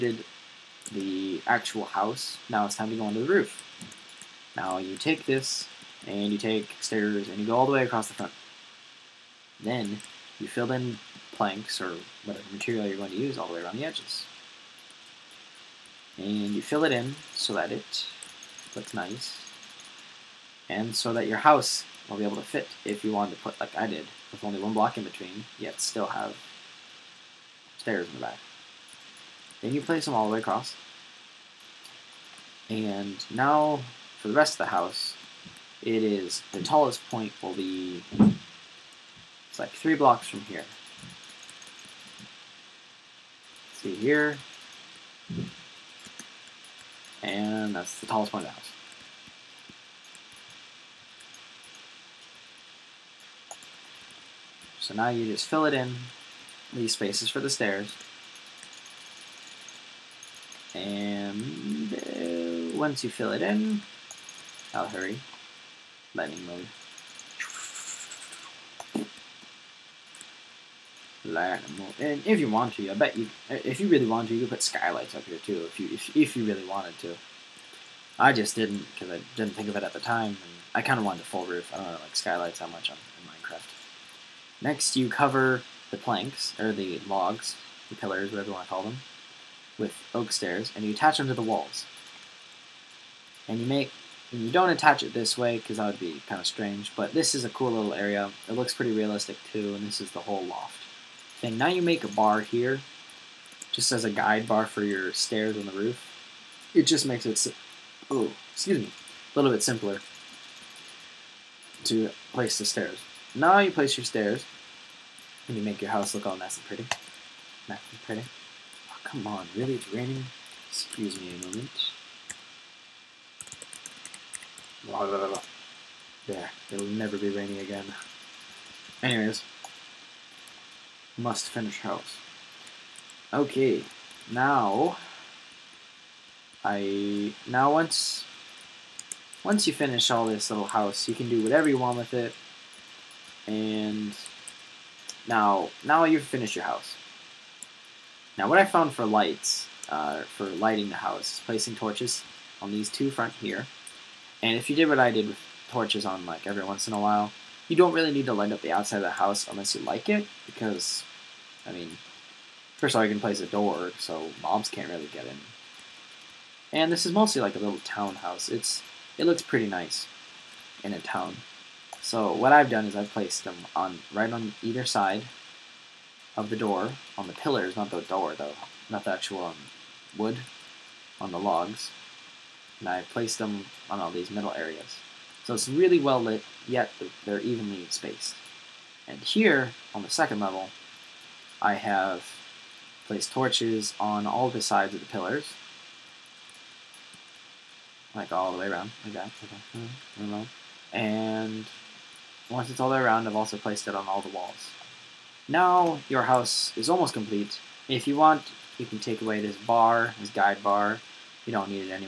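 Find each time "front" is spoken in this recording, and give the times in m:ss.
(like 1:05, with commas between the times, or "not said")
0:08, 2:33.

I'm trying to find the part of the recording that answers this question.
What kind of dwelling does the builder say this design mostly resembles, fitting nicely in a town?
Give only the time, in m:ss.
2:47.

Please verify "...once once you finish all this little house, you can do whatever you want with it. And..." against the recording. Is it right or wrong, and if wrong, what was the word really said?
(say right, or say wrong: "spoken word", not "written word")
right.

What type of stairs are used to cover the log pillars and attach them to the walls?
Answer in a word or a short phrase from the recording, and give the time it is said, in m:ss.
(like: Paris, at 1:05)
Oak stairs, at 1:30.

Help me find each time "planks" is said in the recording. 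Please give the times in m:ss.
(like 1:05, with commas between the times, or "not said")
0:11, 1:25.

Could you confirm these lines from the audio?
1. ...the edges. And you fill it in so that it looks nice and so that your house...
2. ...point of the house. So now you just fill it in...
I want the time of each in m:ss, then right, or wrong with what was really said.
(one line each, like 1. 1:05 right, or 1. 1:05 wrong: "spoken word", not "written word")
1. 0:13 right
2. 0:48 right.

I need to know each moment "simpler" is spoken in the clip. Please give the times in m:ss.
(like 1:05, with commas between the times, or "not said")
1:49.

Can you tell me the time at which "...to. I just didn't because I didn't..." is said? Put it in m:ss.
1:16.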